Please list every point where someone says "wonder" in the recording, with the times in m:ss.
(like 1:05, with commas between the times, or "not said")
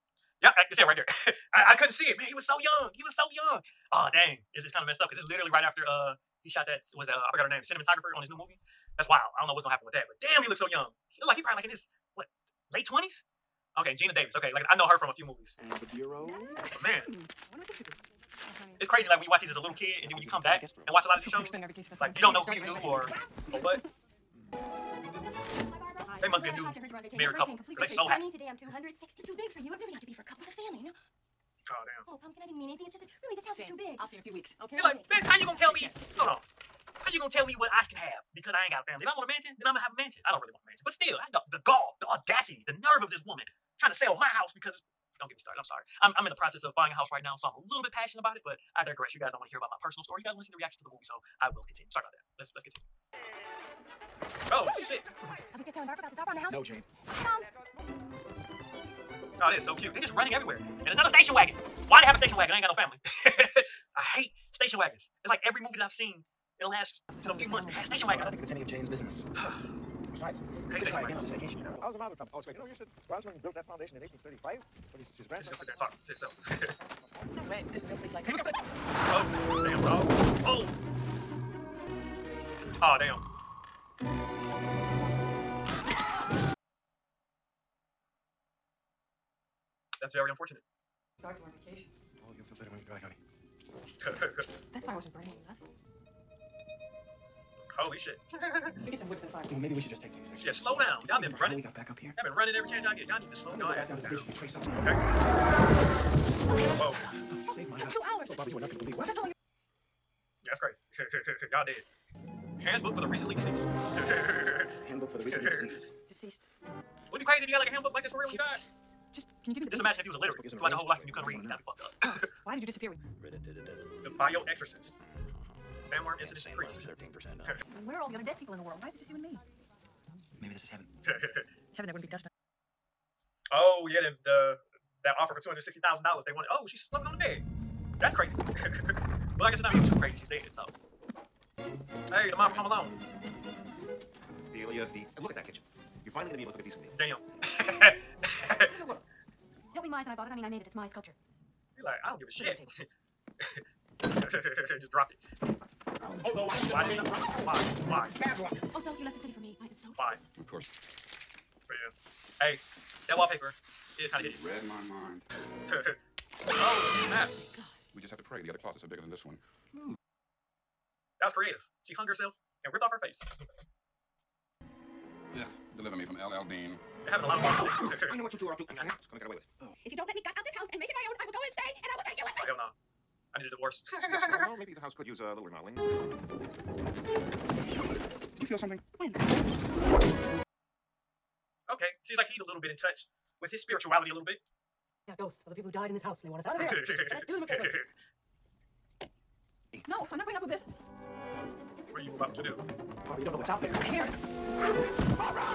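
0:17.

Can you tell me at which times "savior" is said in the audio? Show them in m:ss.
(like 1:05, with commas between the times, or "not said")
not said.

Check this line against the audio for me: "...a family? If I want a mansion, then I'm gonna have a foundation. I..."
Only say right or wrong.
wrong.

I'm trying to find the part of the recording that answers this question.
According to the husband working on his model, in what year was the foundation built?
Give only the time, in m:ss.
1:14.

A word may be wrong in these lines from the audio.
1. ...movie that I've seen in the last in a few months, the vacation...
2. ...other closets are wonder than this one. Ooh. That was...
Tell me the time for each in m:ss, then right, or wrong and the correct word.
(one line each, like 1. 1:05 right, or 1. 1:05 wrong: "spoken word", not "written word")
1. 1:05 wrong: "station", not "vacation"
2. 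2:48 wrong: "bigger", not "wonder".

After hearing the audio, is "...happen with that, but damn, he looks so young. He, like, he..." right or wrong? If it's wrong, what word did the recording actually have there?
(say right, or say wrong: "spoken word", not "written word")
right.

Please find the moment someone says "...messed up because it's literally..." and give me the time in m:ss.
0:04.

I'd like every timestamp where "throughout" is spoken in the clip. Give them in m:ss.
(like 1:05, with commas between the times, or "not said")
2:00.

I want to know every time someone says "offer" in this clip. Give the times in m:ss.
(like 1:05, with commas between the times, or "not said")
0:56, 2:15.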